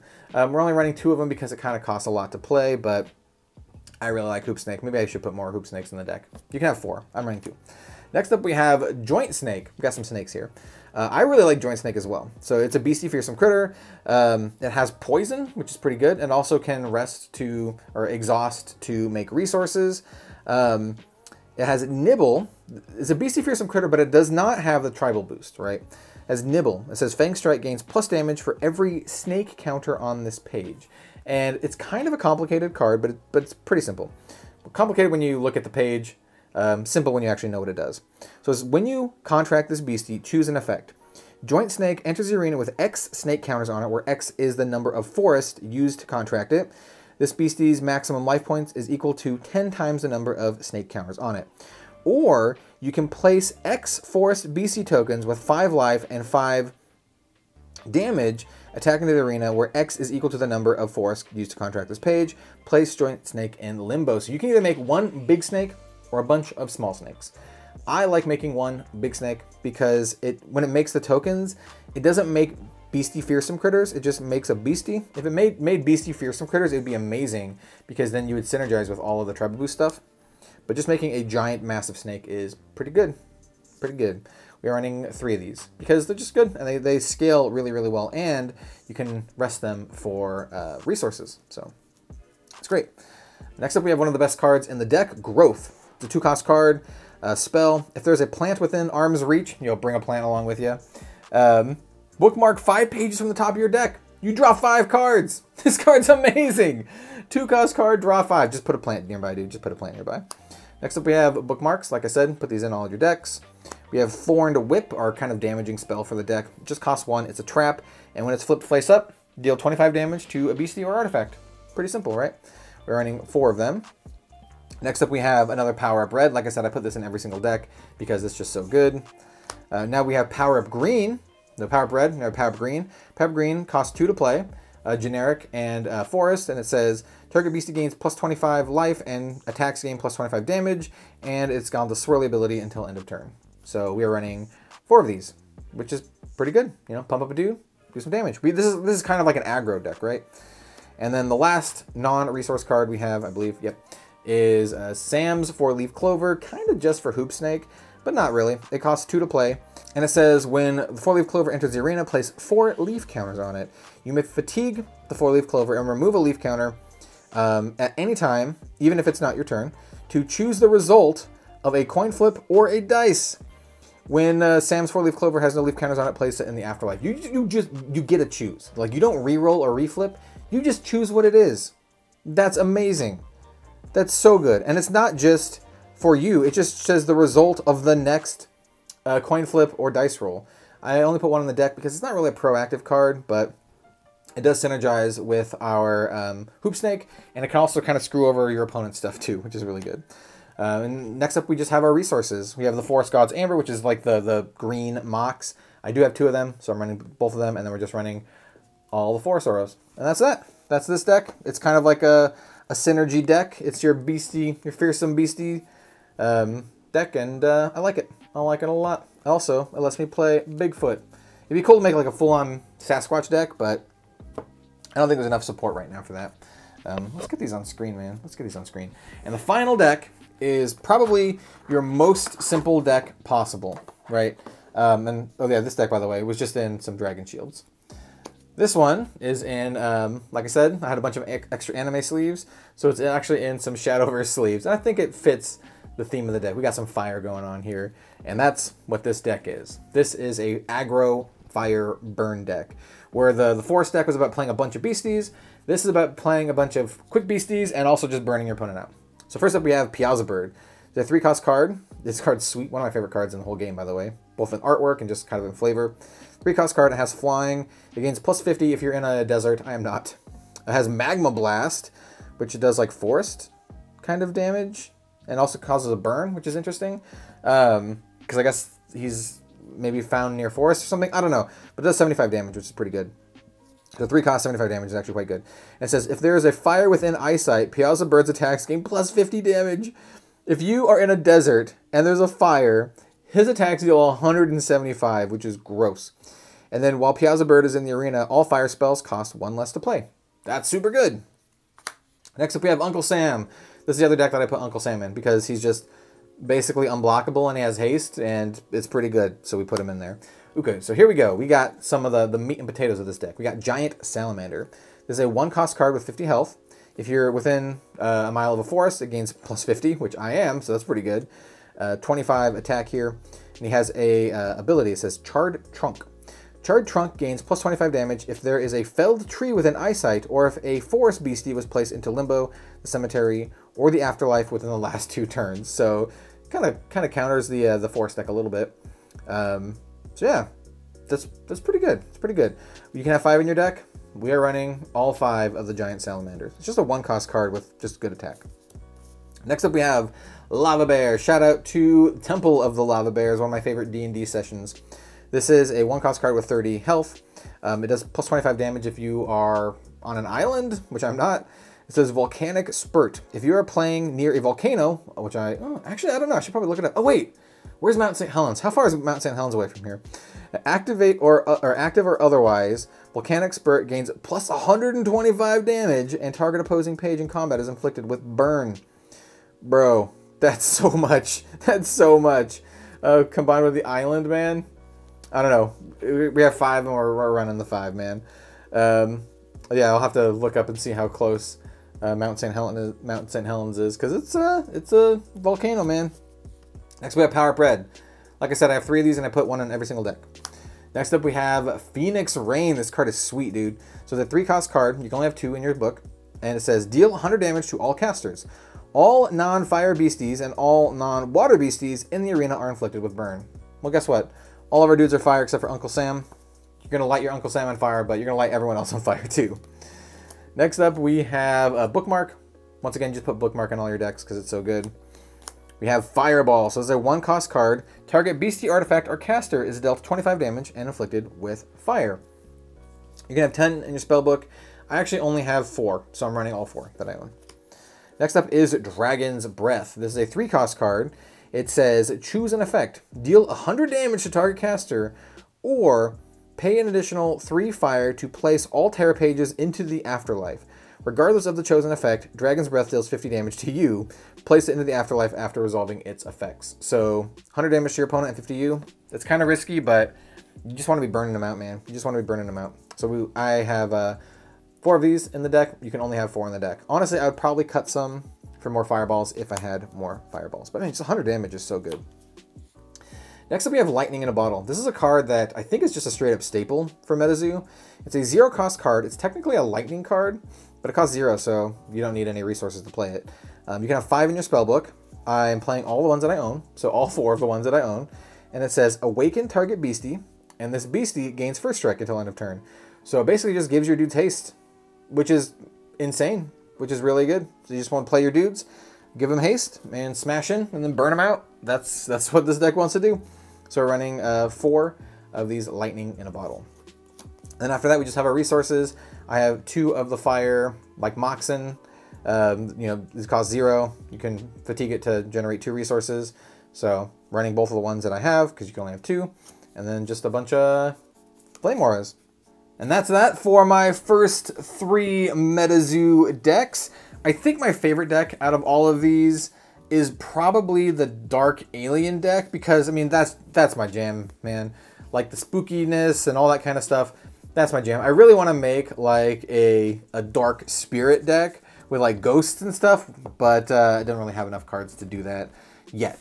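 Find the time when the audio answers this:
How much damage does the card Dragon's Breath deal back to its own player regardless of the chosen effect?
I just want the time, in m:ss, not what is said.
7:33.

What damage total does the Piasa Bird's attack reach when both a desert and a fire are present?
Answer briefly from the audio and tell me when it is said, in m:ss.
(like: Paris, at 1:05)
175, at 4:54.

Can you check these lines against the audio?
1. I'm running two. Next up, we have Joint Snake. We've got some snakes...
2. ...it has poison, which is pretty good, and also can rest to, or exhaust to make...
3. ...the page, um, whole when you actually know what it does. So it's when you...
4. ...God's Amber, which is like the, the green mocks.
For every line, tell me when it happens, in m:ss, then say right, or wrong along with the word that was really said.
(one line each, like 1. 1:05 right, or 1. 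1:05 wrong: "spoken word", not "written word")
1. 0:07 right
2. 0:14 right
3. 0:35 wrong: "simple", not "whole"
4. 3:23 right.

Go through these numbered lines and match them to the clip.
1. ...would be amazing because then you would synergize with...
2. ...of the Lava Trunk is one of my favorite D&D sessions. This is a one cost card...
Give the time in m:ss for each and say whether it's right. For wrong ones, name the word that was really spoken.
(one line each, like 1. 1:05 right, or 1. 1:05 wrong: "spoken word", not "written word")
1. 1:16 right
2. 5:52 wrong: "Bear", not "Trunk".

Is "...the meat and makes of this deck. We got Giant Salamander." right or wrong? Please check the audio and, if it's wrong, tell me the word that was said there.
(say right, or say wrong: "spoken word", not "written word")
wrong: "potatoes", not "makes".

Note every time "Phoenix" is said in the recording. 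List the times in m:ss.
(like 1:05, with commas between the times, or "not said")
6:41.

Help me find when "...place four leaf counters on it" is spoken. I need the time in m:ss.
2:42.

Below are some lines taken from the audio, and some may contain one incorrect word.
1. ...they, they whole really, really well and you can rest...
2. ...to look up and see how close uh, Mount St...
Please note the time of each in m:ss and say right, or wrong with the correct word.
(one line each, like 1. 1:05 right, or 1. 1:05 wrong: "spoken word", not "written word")
1. 1:26 wrong: "scale", not "whole"
2. 6:30 right.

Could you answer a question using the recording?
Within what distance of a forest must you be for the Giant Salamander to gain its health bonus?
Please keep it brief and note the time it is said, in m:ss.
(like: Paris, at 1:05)
a mile, at 5:18.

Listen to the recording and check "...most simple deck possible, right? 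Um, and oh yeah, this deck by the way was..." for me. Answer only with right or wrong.
right.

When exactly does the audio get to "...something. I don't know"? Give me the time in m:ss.
4:40.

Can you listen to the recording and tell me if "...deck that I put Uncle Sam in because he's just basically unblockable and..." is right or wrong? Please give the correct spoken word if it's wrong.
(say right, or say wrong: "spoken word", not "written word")
right.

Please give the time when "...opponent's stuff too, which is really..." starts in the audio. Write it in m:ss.
3:18.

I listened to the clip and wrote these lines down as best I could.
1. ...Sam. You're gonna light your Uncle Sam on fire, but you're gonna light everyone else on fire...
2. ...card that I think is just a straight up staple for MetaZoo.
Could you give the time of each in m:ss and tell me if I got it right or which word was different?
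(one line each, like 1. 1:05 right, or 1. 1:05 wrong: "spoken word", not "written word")
1. 6:55 right
2. 7:54 right.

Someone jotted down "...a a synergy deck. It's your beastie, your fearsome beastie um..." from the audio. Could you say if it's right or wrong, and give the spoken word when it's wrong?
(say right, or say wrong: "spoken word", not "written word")
right.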